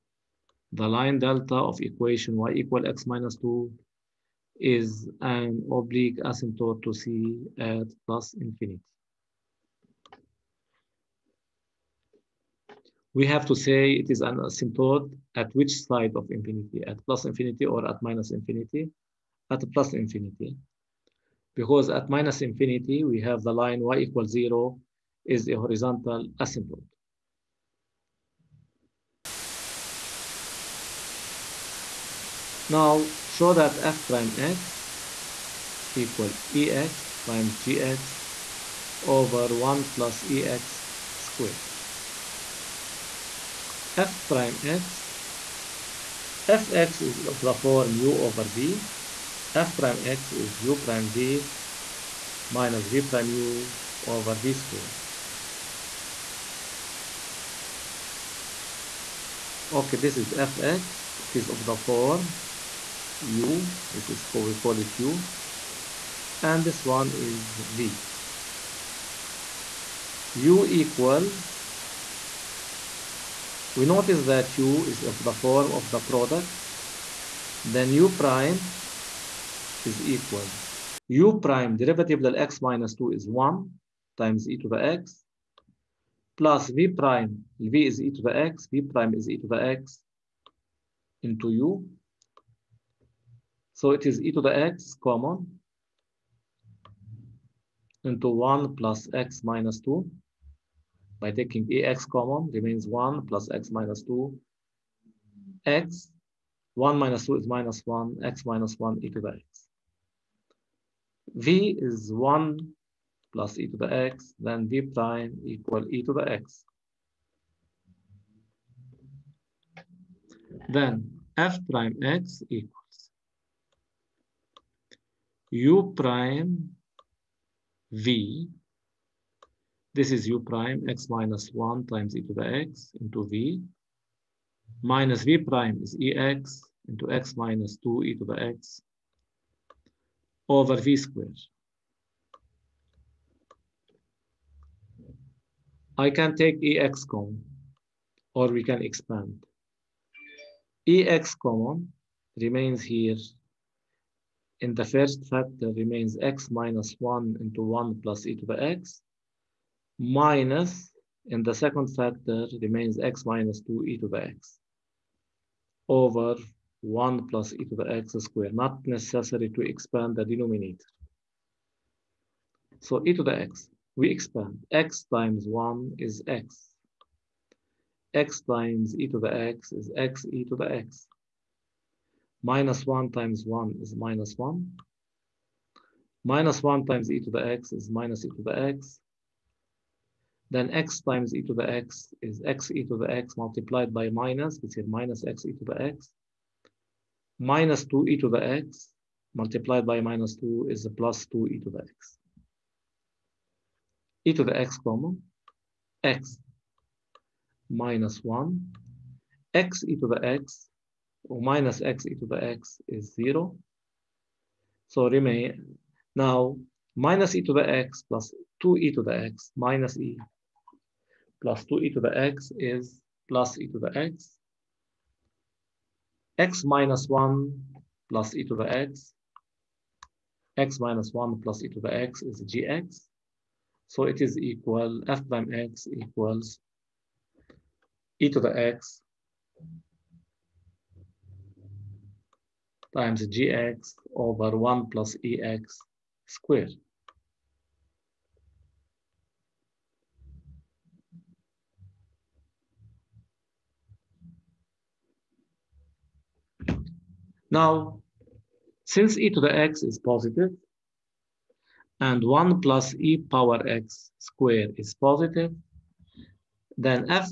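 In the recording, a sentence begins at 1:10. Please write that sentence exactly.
u equals, we notice that u is of the form of the product.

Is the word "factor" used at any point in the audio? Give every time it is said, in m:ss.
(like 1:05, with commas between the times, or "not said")
2:35, 2:41.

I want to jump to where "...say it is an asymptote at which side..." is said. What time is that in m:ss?
0:13.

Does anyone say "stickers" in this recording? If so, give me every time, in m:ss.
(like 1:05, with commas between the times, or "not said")
not said.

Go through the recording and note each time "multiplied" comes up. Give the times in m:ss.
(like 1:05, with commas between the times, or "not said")
3:13, 3:19.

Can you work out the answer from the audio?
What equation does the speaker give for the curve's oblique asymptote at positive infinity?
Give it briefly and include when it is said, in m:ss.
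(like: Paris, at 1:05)
y = x - 2, at 0:02.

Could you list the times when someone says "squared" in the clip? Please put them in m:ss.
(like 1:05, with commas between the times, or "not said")
0:41, 0:54, 2:20, 2:48, 4:06, 4:24.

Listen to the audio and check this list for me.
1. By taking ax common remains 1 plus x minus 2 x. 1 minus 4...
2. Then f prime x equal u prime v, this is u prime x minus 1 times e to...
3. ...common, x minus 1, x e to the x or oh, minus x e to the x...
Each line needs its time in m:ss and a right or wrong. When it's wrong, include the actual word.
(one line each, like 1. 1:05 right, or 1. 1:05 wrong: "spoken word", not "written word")
1. 1:41 wrong: "2", not "4"
2. 2:00 right
3. 3:24 right.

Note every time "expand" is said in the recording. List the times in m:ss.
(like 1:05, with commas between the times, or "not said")
2:28, 2:49, 2:54.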